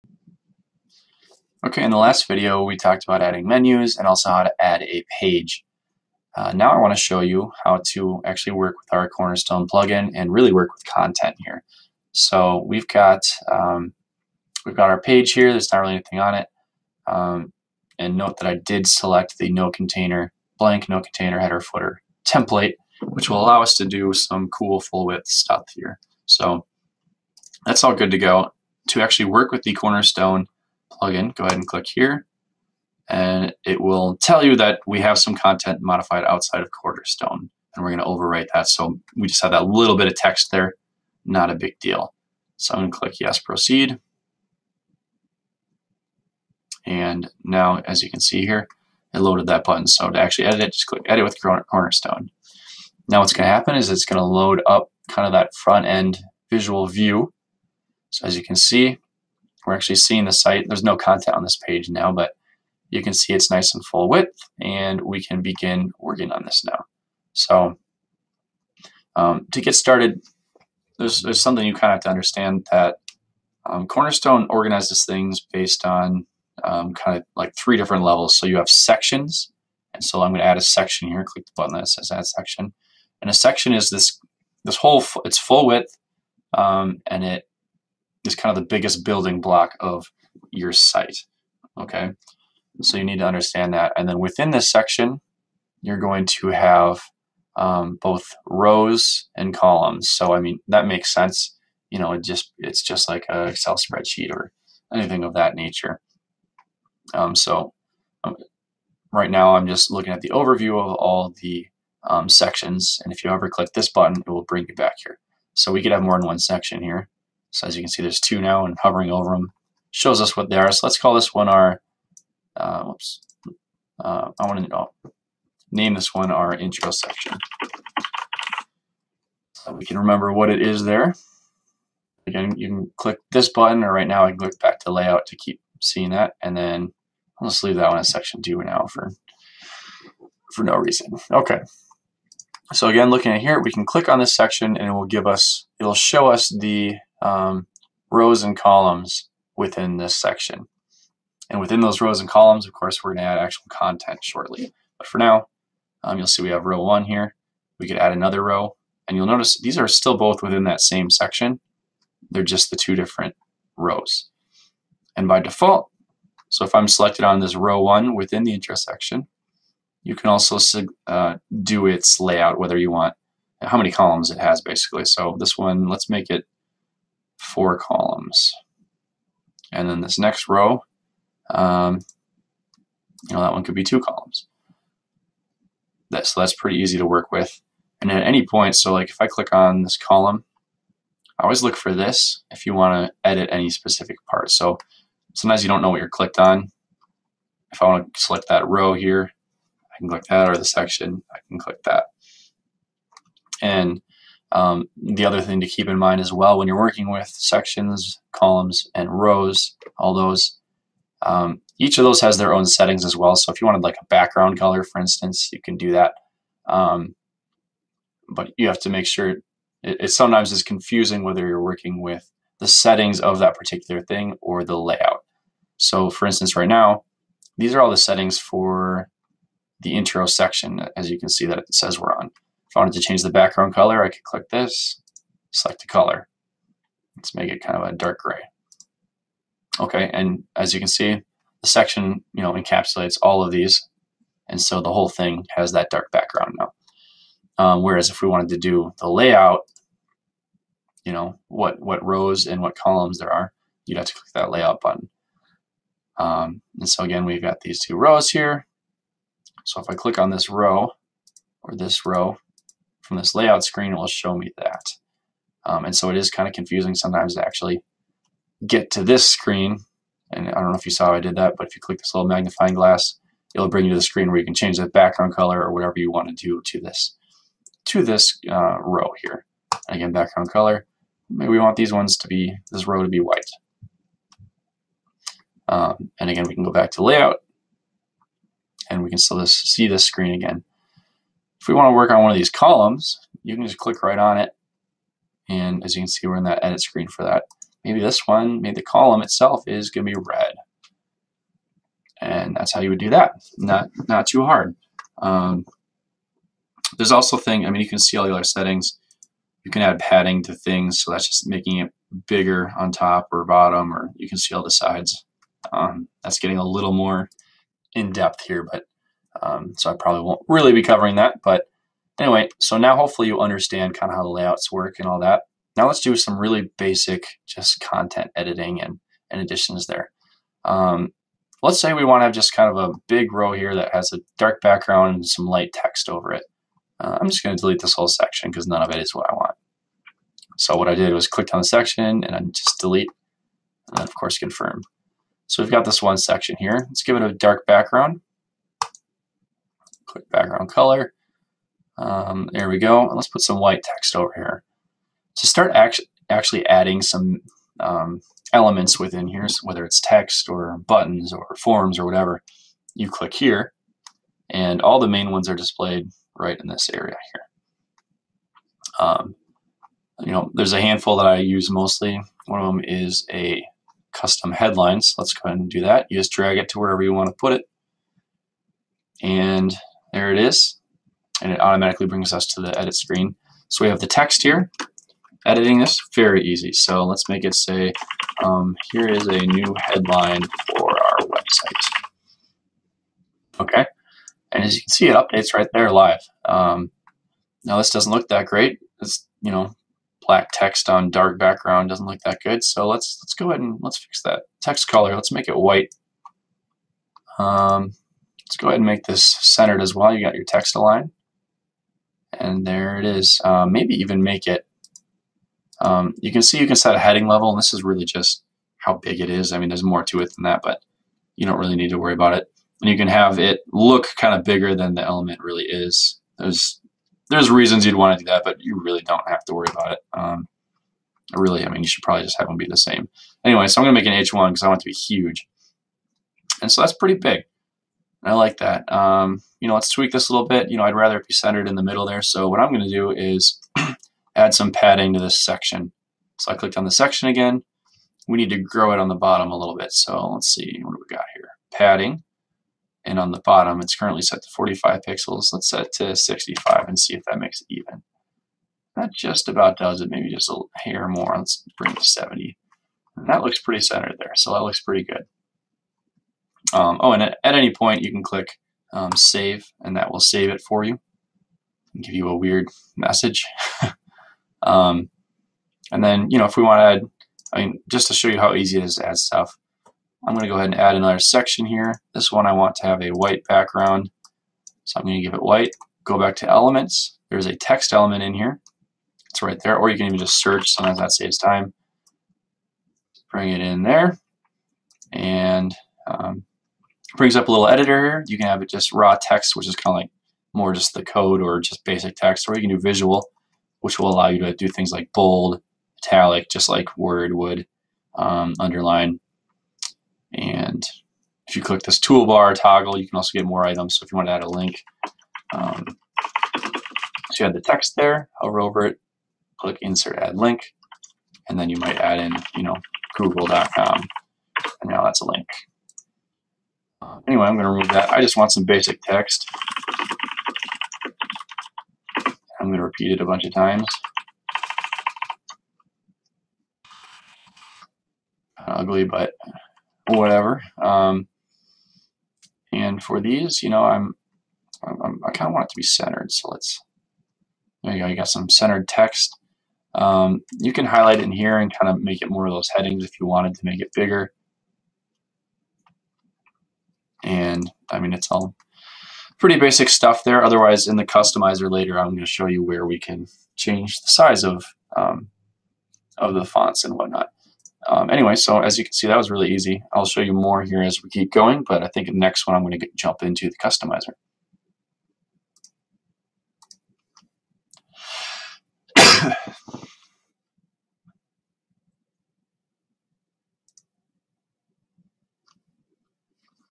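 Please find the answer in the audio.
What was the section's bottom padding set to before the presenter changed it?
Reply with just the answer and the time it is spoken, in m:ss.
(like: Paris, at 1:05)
45 pixels, at 7:34.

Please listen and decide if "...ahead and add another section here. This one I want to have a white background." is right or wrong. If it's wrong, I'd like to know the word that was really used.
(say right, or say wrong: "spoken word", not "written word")
right.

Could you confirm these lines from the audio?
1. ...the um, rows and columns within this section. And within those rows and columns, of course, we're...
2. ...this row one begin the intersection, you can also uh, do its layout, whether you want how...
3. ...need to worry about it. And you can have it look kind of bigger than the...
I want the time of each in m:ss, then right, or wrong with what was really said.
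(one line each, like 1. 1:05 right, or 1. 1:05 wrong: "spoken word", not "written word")
1. 2:26 right
2. 2:47 wrong: "within", not "begin"
3. 7:01 right.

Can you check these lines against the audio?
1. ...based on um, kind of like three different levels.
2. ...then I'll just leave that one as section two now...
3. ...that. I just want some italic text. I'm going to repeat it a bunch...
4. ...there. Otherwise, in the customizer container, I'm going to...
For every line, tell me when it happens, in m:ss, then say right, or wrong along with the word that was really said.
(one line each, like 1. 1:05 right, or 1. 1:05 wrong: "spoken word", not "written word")
1. 1:15 right
2. 2:16 right
3. 8:47 wrong: "basic", not "italic"
4. 9:20 wrong: "later", not "container".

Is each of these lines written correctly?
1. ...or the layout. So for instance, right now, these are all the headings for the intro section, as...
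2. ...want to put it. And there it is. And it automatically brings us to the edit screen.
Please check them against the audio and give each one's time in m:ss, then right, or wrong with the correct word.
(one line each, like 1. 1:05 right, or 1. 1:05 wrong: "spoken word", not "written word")
1. 3:44 wrong: "settings", not "headings"
2. 6:17 right.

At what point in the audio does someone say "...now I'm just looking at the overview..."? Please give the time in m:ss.
1:49.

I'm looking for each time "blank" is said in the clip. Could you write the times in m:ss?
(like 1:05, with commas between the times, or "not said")
0:20.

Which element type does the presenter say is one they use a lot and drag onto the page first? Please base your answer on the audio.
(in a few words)
Custom headline.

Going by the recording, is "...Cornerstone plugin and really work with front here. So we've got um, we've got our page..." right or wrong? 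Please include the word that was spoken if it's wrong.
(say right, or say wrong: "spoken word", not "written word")
wrong: "content", not "front".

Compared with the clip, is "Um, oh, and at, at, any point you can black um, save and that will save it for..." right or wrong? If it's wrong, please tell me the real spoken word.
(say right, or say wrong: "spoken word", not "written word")
wrong: "click", not "black".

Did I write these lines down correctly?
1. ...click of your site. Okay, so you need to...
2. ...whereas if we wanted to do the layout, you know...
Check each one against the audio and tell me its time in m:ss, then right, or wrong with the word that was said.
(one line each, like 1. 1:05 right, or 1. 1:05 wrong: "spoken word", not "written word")
1. 1:29 wrong: "block", not "click"
2. 4:07 right.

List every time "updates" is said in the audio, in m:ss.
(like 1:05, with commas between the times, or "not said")
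6:35.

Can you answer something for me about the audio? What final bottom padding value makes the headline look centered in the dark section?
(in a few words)
70.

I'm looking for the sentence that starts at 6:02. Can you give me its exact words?
You click here, and all the main ones are displayed right in this area here.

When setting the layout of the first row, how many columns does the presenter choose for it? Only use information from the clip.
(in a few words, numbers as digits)
4.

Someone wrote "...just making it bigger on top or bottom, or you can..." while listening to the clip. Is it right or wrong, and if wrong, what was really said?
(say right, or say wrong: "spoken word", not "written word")
right.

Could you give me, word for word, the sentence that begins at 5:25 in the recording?
Now let's do some really basic just content editing and, and additions there.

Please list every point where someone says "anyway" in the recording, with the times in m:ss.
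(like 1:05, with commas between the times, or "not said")
5:22, 7:13, 8:47, 9:28.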